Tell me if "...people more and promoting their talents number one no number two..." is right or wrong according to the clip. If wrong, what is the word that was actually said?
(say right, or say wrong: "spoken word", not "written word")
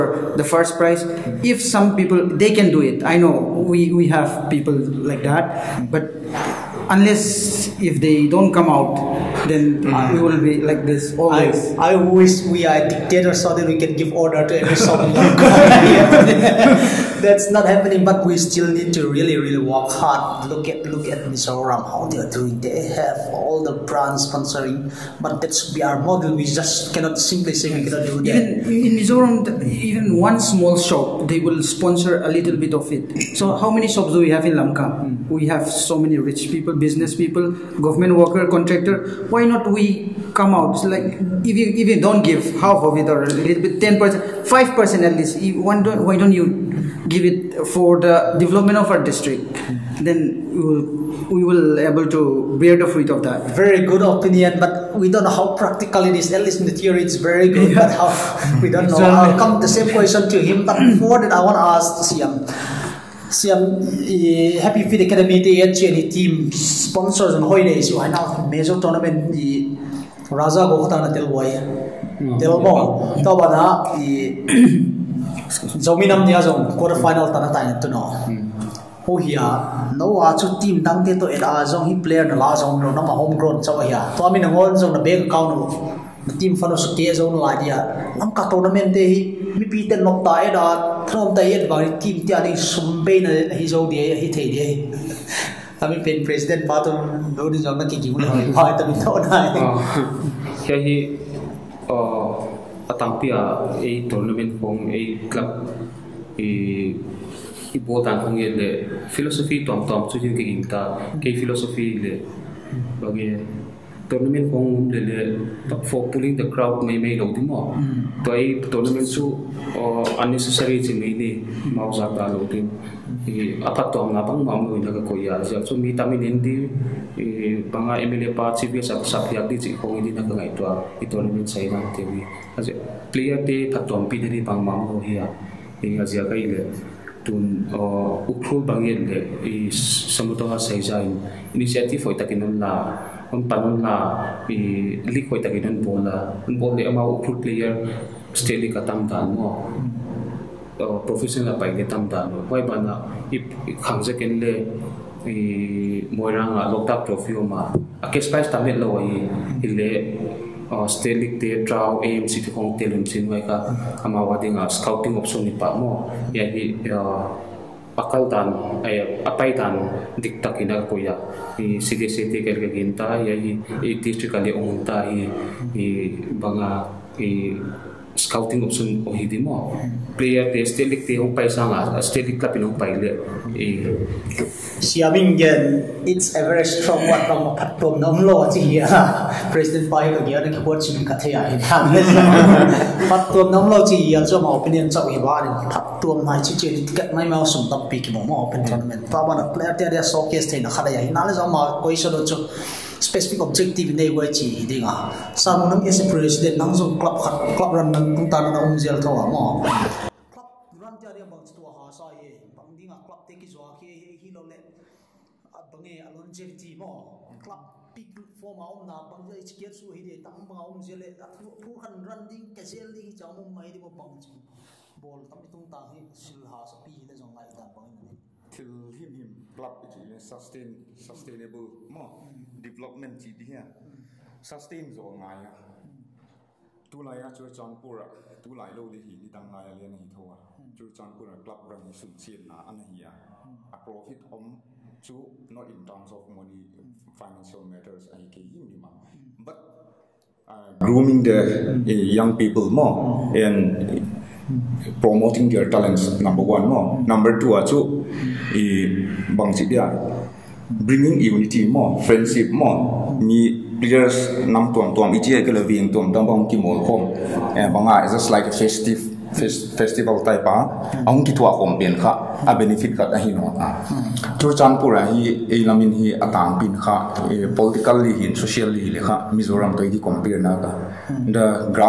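right.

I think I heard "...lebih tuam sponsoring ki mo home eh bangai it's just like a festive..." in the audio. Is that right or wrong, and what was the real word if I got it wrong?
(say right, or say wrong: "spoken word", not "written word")
wrong: "tambang", not "sponsoring".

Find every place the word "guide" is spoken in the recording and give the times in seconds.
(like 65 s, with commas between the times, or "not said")
not said.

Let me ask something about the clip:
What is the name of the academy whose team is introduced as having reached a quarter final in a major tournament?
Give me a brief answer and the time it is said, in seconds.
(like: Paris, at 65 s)
Happy Feet Academy, at 64 s.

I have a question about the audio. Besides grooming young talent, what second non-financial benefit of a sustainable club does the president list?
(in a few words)
bringing unity.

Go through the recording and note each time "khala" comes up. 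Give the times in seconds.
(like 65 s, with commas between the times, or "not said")
200 s.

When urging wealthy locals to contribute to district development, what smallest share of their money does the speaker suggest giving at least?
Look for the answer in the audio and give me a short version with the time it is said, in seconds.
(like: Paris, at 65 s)
5 percent, at 44 s.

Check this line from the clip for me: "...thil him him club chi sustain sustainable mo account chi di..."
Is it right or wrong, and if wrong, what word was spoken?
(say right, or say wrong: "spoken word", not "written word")
wrong: "development", not "account".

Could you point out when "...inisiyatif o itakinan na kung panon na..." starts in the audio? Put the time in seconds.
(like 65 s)
141 s.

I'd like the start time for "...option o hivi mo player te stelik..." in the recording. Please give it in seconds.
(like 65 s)
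178 s.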